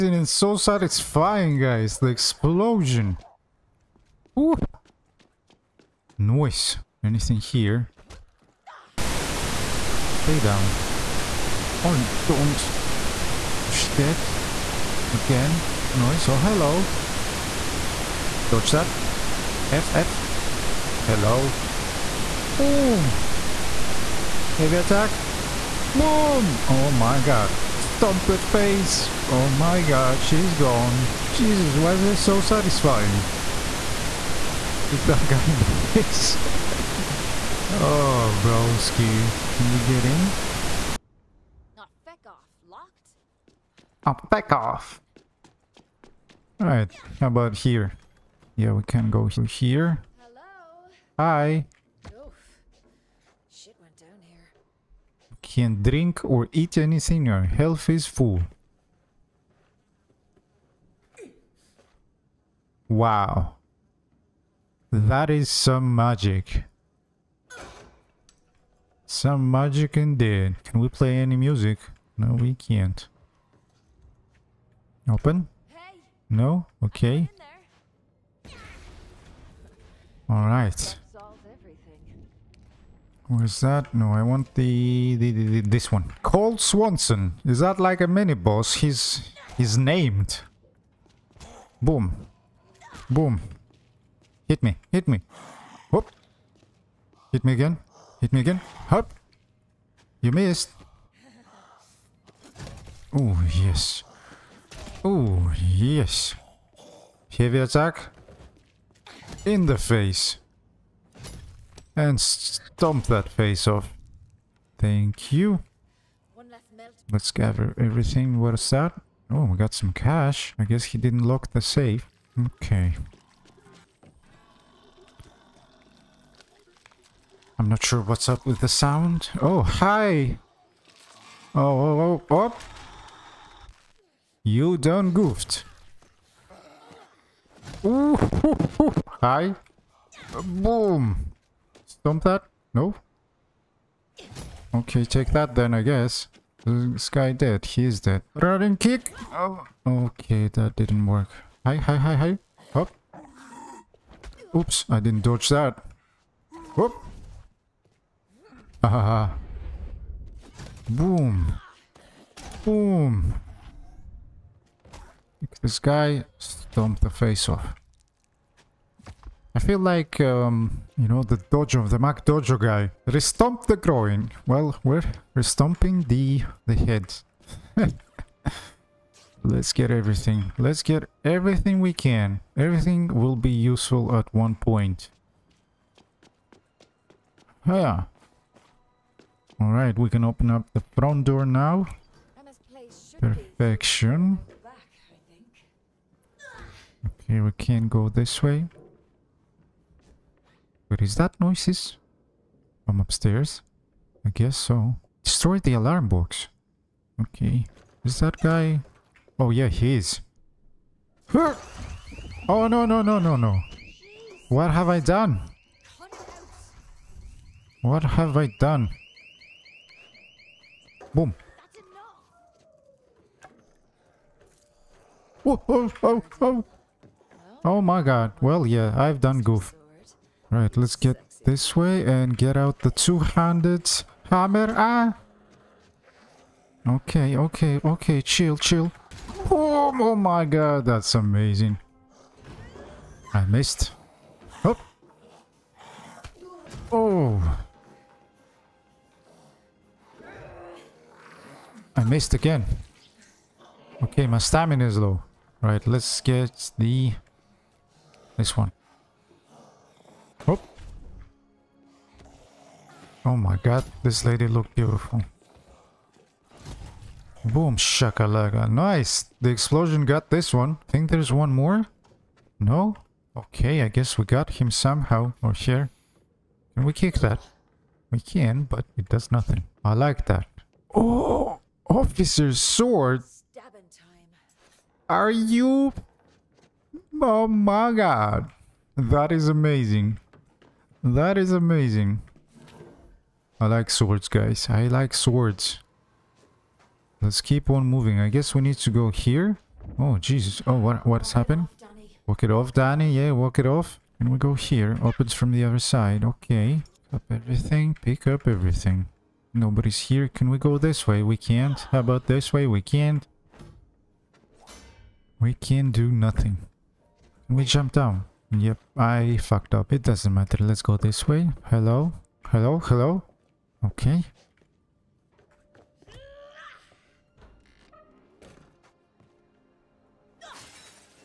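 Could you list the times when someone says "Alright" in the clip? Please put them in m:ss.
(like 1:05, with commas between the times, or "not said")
0:46, 1:20, 3:09.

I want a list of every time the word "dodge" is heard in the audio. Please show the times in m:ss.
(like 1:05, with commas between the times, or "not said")
0:18, 2:35.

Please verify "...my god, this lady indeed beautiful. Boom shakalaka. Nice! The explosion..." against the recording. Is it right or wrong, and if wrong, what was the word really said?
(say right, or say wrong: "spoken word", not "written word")
wrong: "looked", not "indeed".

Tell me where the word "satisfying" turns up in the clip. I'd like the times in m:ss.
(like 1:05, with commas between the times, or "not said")
0:00, 0:32.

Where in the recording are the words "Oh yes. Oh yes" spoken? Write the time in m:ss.
1:43.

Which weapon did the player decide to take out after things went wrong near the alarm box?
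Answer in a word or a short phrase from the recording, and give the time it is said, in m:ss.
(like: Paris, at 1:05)
two-handed hammer, at 3:52.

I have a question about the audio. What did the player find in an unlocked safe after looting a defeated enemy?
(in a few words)
cash.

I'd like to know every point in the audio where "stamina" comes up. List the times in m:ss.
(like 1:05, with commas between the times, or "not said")
4:14.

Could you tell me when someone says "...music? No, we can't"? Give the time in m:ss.
1:11.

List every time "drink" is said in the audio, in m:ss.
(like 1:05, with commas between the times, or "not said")
0:55.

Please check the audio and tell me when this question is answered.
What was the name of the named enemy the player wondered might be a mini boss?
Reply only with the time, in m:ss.
1:26.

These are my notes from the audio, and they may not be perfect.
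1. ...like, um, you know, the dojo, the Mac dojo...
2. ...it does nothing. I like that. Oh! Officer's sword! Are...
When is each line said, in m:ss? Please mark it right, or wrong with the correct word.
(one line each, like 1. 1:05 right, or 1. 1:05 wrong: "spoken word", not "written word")
1. 2:49 right
2. 4:38 right.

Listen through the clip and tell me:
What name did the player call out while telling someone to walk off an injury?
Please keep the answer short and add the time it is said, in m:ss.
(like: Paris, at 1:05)
Dani, at 5:02.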